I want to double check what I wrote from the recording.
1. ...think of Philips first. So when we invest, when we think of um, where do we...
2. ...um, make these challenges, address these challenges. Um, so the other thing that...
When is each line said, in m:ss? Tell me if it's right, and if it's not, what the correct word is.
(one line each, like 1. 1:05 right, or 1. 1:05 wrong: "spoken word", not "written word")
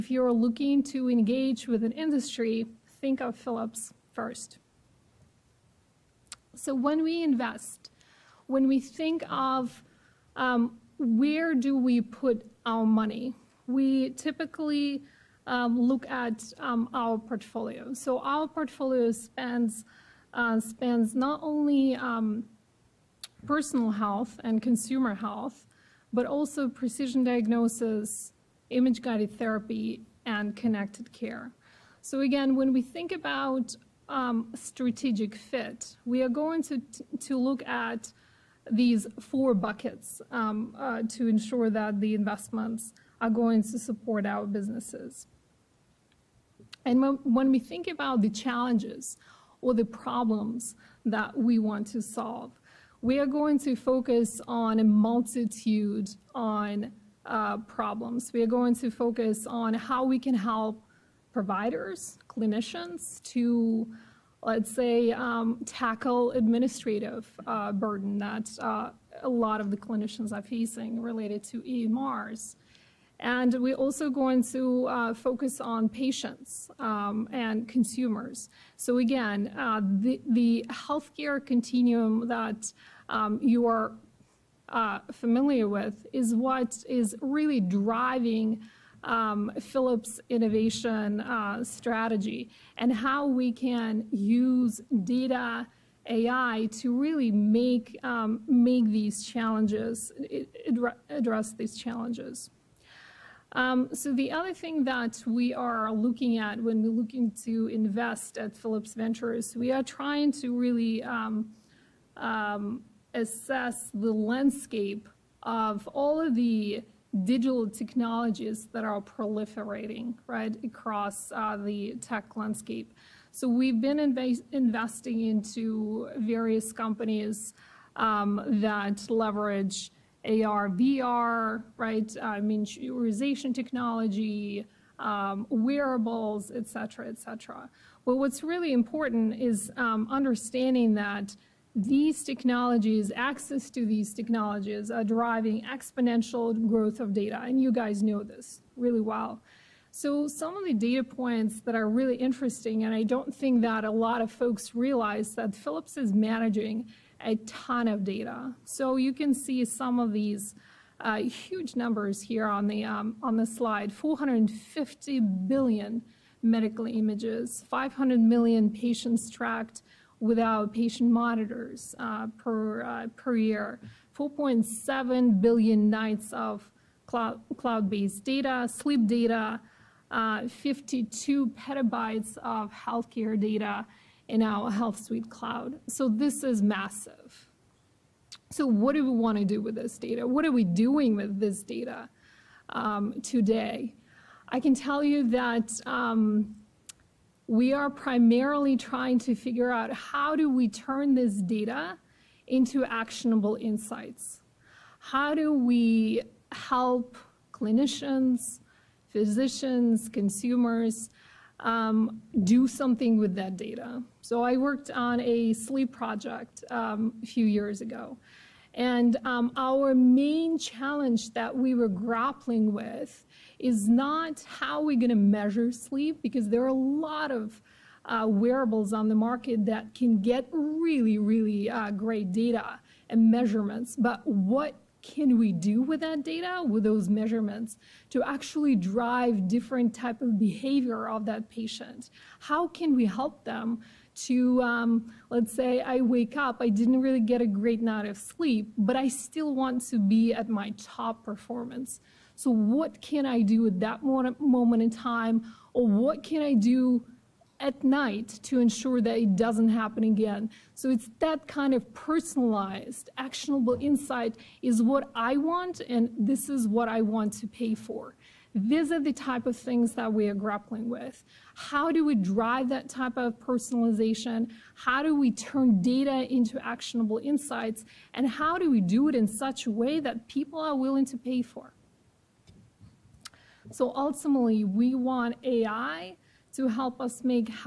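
1. 0:03 right
2. 1:38 right.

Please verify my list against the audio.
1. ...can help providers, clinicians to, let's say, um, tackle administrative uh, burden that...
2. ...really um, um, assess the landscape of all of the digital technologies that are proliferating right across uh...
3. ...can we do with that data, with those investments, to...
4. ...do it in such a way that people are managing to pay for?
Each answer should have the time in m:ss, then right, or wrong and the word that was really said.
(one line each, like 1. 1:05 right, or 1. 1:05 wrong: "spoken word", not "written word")
1. 1:00 right
2. 1:50 right
3. 3:55 wrong: "measurements", not "investments"
4. 4:38 wrong: "willing", not "managing".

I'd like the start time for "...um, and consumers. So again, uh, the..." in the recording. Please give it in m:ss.
1:16.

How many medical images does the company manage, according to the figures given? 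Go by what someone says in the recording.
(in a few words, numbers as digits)
450 billion.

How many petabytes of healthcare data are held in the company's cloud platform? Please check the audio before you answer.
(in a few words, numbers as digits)
52.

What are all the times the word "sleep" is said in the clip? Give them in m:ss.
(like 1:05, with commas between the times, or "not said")
2:58, 3:35, 3:45, 4:08.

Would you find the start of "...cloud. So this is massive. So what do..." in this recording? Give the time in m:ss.
3:05.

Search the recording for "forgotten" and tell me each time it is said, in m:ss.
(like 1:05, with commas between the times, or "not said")
not said.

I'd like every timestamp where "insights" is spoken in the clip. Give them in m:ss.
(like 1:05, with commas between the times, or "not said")
3:23, 4:23, 4:37.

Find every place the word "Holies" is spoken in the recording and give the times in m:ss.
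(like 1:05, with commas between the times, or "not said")
not said.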